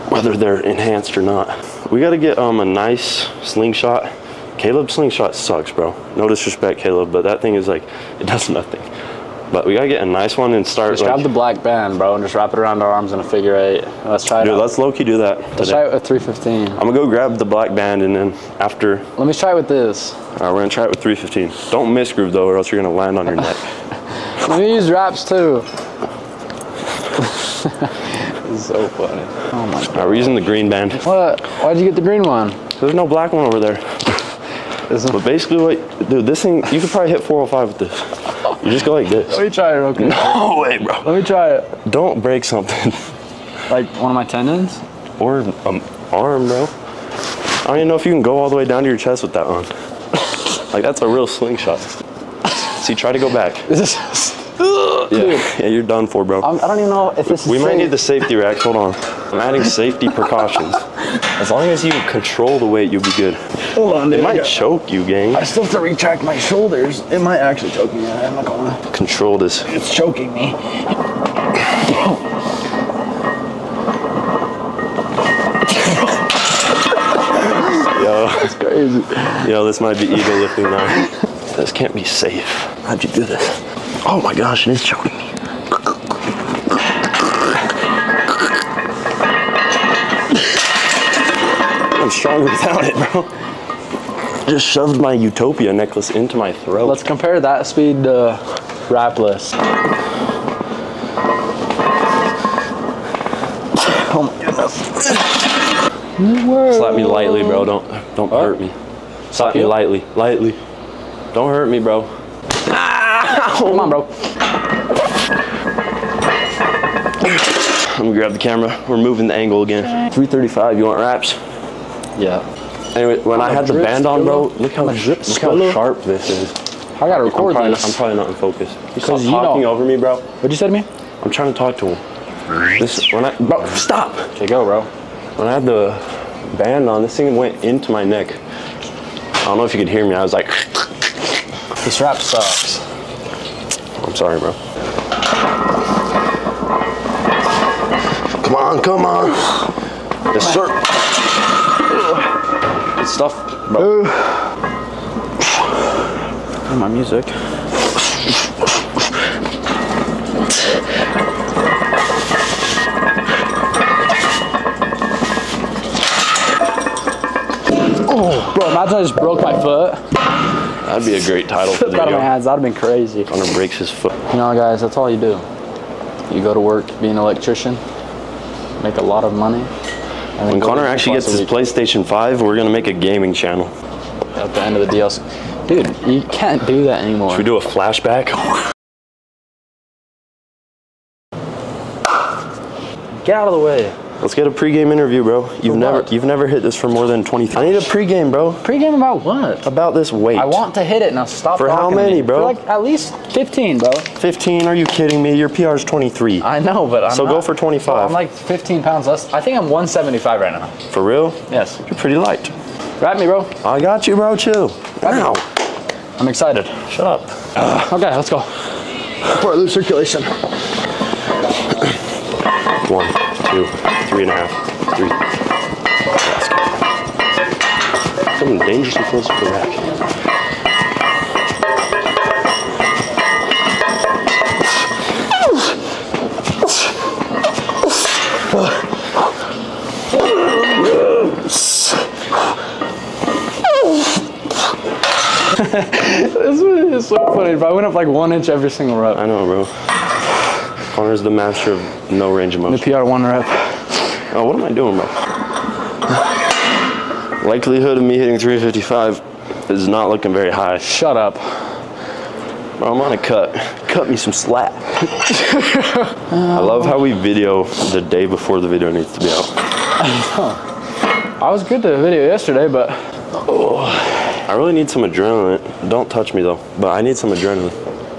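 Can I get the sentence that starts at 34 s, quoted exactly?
But basically, what, dude, this thing, you could probably hit 405 with this.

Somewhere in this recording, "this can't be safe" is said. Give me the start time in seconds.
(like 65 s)
81 s.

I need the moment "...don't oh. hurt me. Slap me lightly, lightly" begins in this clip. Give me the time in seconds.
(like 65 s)
108 s.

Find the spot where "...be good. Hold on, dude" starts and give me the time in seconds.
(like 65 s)
63 s.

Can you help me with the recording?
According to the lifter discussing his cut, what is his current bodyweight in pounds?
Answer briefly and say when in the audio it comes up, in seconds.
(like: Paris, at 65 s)
175, at 209 s.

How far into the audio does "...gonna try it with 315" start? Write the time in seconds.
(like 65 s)
20 s.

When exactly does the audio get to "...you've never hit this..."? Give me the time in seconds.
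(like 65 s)
196 s.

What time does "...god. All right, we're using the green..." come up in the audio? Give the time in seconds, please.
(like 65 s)
29 s.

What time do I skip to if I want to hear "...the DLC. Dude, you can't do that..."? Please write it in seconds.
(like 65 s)
184 s.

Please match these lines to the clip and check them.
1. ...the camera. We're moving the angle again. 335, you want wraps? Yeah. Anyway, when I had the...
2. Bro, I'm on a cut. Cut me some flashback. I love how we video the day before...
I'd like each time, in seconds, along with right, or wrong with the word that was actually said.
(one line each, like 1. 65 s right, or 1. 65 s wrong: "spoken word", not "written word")
1. 118 s right
2. 262 s wrong: "slack", not "flashback".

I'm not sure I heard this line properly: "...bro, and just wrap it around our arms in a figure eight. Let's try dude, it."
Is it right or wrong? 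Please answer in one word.
right.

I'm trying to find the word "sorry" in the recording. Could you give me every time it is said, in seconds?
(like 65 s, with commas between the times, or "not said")
144 s.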